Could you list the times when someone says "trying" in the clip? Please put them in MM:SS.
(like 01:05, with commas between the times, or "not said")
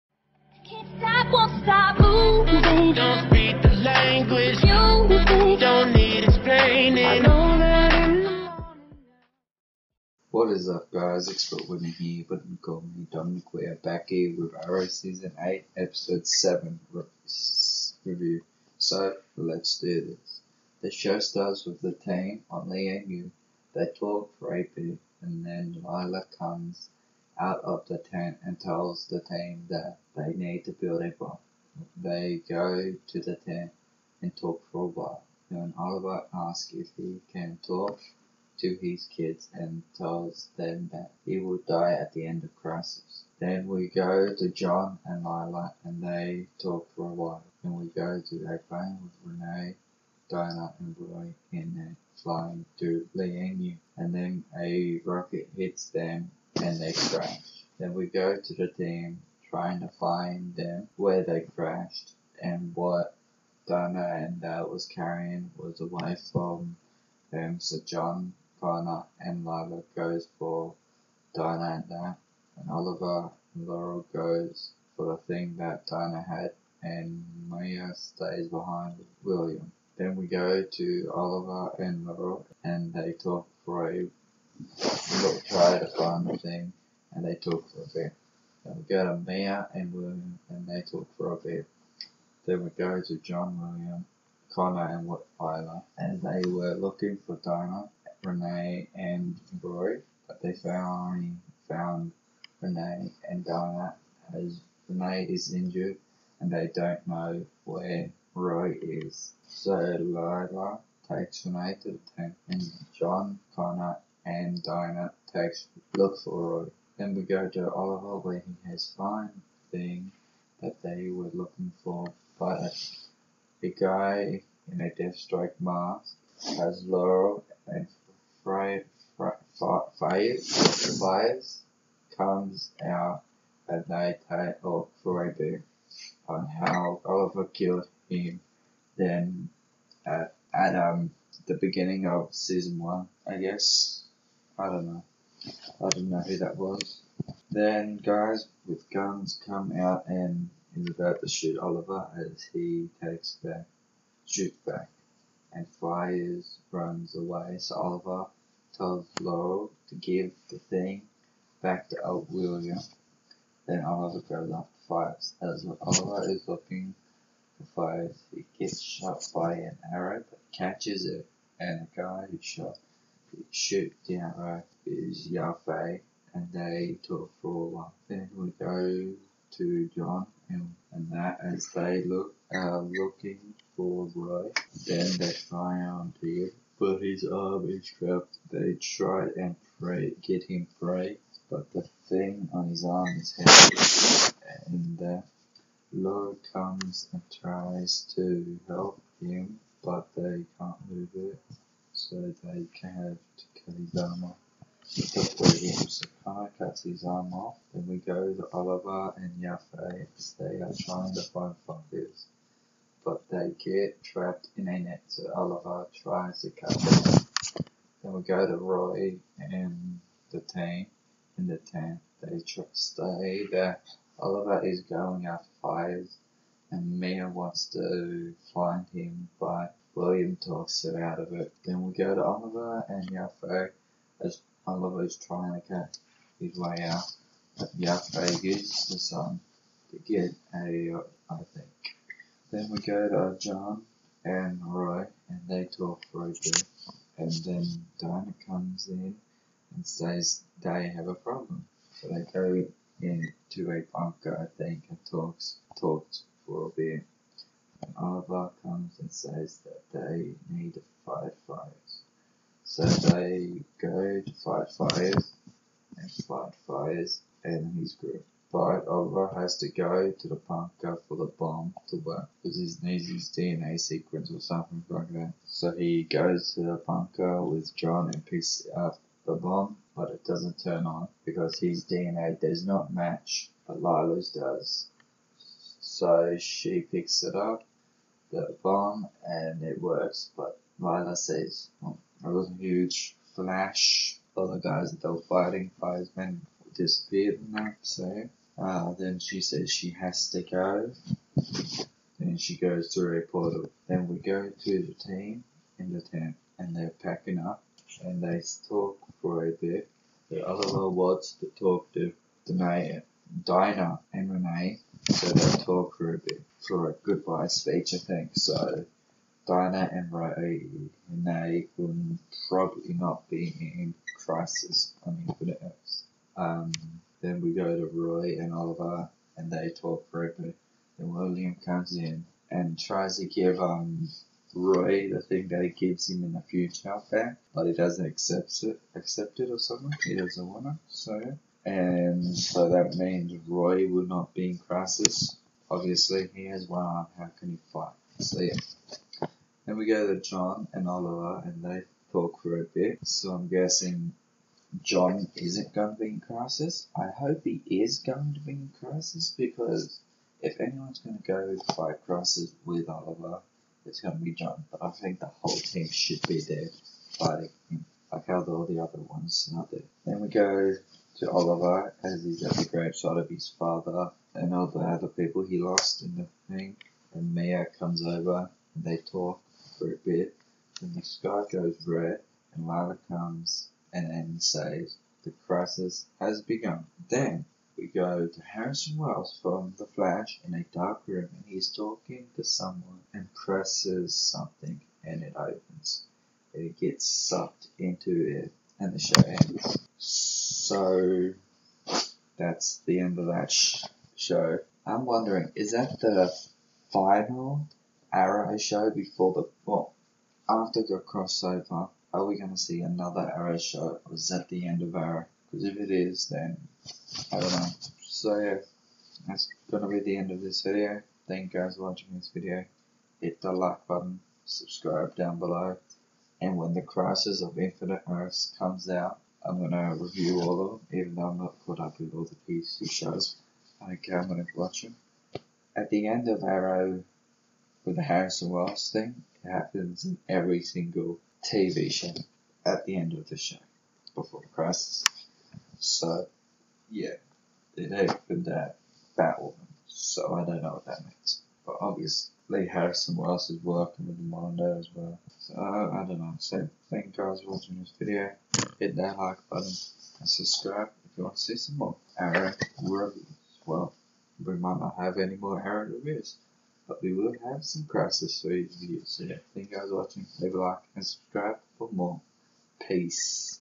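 00:59, 03:30, 03:55.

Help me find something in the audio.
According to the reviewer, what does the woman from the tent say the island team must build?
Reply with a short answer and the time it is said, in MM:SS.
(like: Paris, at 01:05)
A bomb, at 00:30.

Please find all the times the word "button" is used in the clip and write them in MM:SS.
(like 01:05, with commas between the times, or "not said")
07:03, 07:39.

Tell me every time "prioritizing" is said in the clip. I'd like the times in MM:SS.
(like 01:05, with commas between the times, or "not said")
not said.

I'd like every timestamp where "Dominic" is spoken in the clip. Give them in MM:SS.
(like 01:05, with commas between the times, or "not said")
00:13.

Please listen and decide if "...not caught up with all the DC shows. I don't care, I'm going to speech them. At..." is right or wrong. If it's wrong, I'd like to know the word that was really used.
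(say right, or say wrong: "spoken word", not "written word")
wrong: "watch", not "speech".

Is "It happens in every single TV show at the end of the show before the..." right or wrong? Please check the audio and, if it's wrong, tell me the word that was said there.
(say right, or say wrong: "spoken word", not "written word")
right.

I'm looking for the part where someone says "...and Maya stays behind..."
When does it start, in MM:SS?
01:16.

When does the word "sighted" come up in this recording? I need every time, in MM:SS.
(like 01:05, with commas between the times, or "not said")
not said.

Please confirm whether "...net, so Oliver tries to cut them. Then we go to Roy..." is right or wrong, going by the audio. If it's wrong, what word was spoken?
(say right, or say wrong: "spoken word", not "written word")
right.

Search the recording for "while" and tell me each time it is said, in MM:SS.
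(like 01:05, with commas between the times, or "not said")
00:34, 00:47.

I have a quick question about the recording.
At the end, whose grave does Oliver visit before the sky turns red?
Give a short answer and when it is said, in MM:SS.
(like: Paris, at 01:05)
His father's, at 06:13.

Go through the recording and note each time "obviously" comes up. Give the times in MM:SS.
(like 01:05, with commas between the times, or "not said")
05:45, 07:31.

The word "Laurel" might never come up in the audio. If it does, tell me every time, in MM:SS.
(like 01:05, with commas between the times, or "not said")
01:13, 01:22, 02:06, 02:39.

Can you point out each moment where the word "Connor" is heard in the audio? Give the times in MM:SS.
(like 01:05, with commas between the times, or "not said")
01:08, 01:34, 01:53.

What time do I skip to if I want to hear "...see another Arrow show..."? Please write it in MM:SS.
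06:52.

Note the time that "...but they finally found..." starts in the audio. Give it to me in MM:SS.
01:40.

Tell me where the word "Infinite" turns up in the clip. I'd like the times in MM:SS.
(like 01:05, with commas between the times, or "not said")
05:25, 07:07.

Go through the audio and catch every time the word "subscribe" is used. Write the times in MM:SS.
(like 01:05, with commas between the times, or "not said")
07:04, 07:40, 07:51.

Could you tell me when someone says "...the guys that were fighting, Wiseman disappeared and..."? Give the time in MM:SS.
04:54.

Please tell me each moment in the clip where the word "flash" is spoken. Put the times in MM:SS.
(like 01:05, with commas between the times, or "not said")
04:53, 06:29.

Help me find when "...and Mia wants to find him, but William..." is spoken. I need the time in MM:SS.
03:46.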